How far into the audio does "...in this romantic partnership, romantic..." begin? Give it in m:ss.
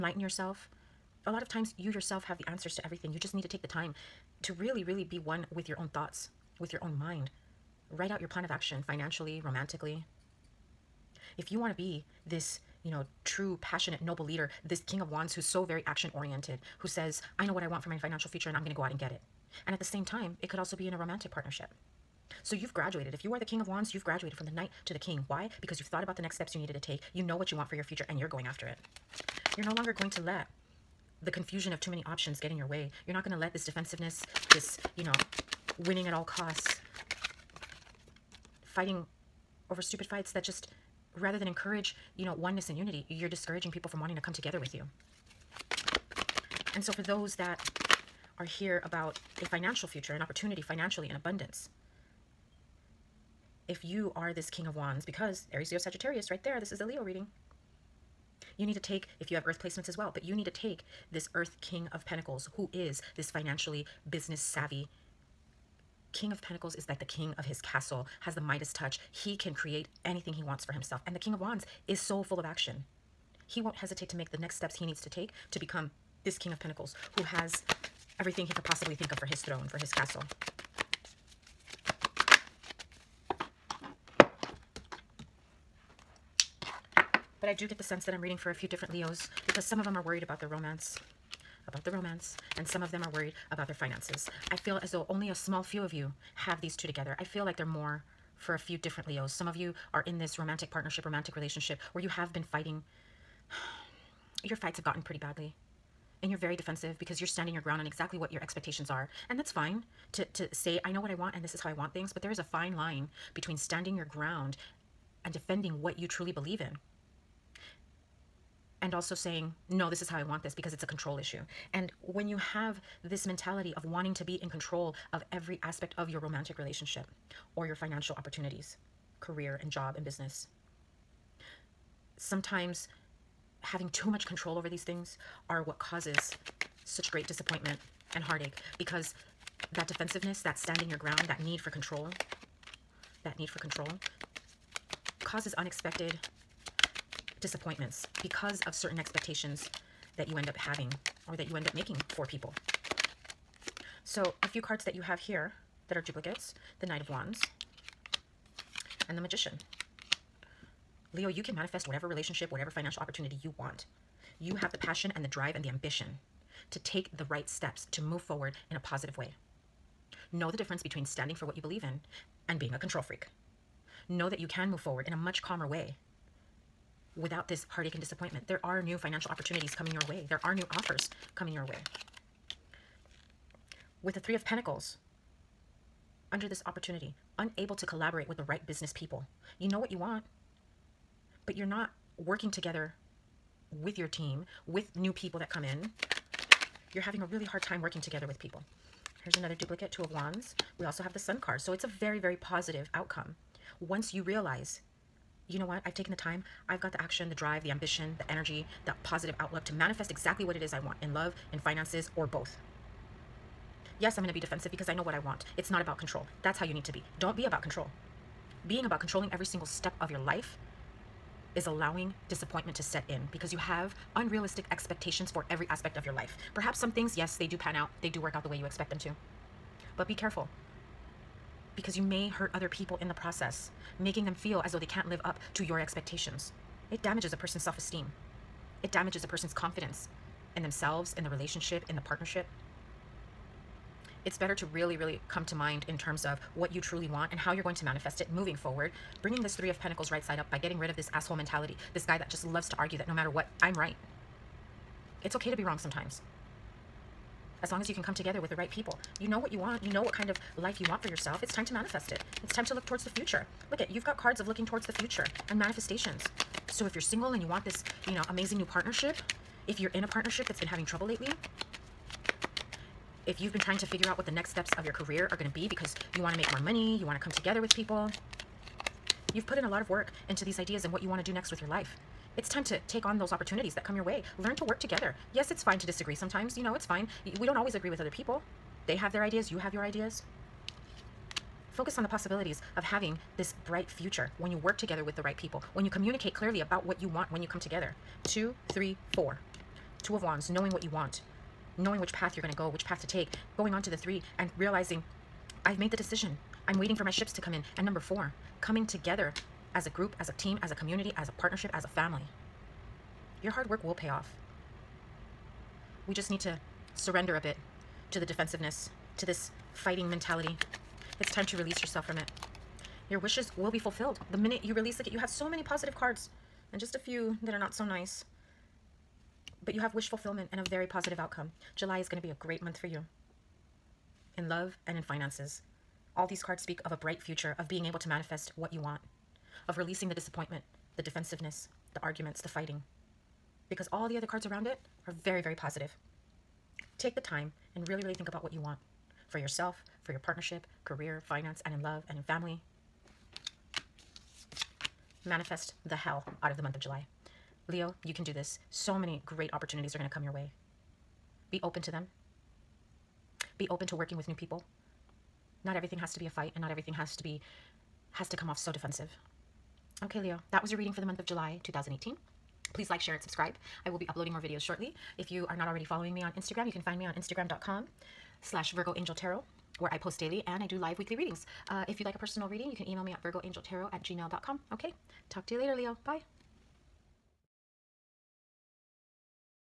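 1:40.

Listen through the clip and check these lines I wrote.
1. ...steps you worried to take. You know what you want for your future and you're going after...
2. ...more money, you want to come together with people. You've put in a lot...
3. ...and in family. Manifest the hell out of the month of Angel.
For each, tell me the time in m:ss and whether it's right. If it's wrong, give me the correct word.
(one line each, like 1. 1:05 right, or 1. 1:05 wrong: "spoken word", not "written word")
1. 0:26 wrong: "needed", not "worried"
2. 4:36 right
3. 5:52 wrong: "July", not "Angel".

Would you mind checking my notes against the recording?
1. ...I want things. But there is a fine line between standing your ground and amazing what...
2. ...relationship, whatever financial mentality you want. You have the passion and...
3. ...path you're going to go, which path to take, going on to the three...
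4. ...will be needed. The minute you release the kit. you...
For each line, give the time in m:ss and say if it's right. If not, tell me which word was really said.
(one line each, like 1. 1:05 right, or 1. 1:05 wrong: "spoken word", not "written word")
1. 1:51 wrong: "defending", not "amazing"
2. 2:42 wrong: "opportunity", not "mentality"
3. 5:02 right
4. 5:23 wrong: "fulfilled", not "needed".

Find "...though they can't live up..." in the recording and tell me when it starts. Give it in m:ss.
3:54.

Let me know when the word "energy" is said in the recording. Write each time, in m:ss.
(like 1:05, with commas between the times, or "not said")
3:28.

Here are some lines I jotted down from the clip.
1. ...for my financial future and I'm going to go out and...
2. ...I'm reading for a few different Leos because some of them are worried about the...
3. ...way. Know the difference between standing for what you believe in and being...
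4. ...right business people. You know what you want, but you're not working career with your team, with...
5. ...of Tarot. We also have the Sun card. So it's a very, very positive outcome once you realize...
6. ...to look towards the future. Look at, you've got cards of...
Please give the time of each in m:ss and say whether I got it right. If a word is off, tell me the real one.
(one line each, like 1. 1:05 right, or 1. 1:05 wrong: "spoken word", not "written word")
1. 0:17 right
2. 1:28 right
3. 2:49 right
4. 3:08 wrong: "together", not "career"
5. 3:20 wrong: "Wands", not "Tarot"
6. 4:22 right.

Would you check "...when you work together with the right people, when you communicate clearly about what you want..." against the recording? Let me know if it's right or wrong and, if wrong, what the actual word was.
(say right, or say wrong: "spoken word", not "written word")
right.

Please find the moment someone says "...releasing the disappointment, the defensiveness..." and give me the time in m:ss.
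5:39.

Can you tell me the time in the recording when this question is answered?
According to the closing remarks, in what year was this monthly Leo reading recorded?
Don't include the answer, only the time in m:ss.
6:11.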